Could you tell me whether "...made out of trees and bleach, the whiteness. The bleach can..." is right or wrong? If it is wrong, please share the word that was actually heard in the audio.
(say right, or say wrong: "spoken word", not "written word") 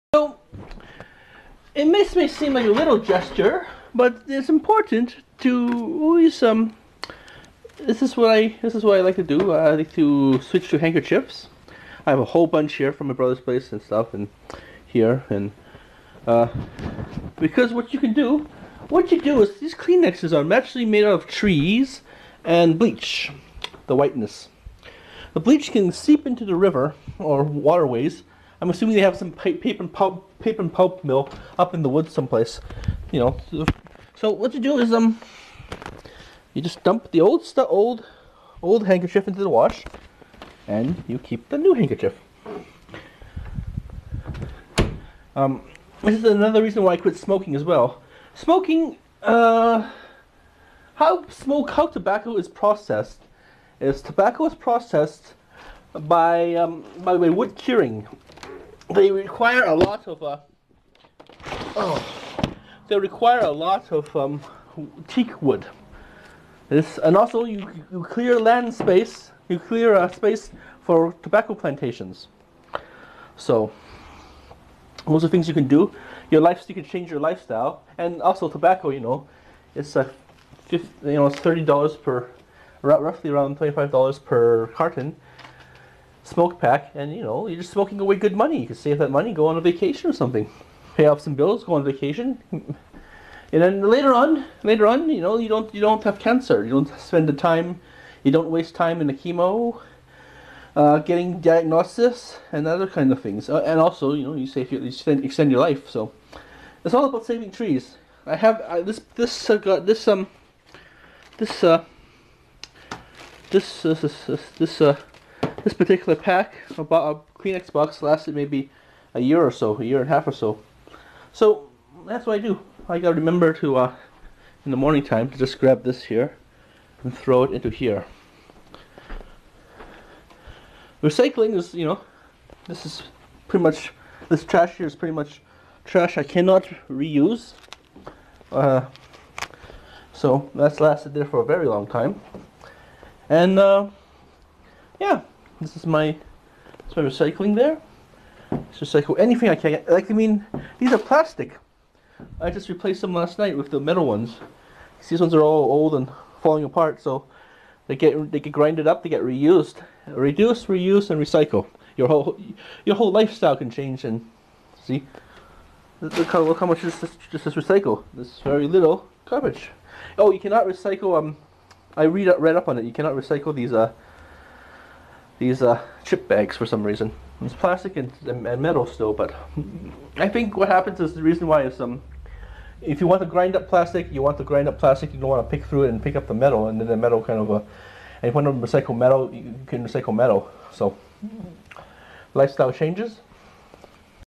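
right.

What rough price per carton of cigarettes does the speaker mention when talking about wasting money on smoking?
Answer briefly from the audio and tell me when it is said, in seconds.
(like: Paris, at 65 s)
$25, at 83 s.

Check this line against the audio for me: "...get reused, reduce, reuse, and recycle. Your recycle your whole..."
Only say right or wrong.
wrong.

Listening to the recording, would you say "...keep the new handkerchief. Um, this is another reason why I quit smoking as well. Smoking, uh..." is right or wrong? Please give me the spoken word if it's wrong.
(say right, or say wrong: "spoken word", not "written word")
right.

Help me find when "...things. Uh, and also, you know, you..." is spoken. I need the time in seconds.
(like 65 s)
103 s.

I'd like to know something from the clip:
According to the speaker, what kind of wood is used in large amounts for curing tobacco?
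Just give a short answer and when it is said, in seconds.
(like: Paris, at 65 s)
teak, at 65 s.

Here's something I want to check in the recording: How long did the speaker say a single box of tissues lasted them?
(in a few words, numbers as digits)
a year and a half.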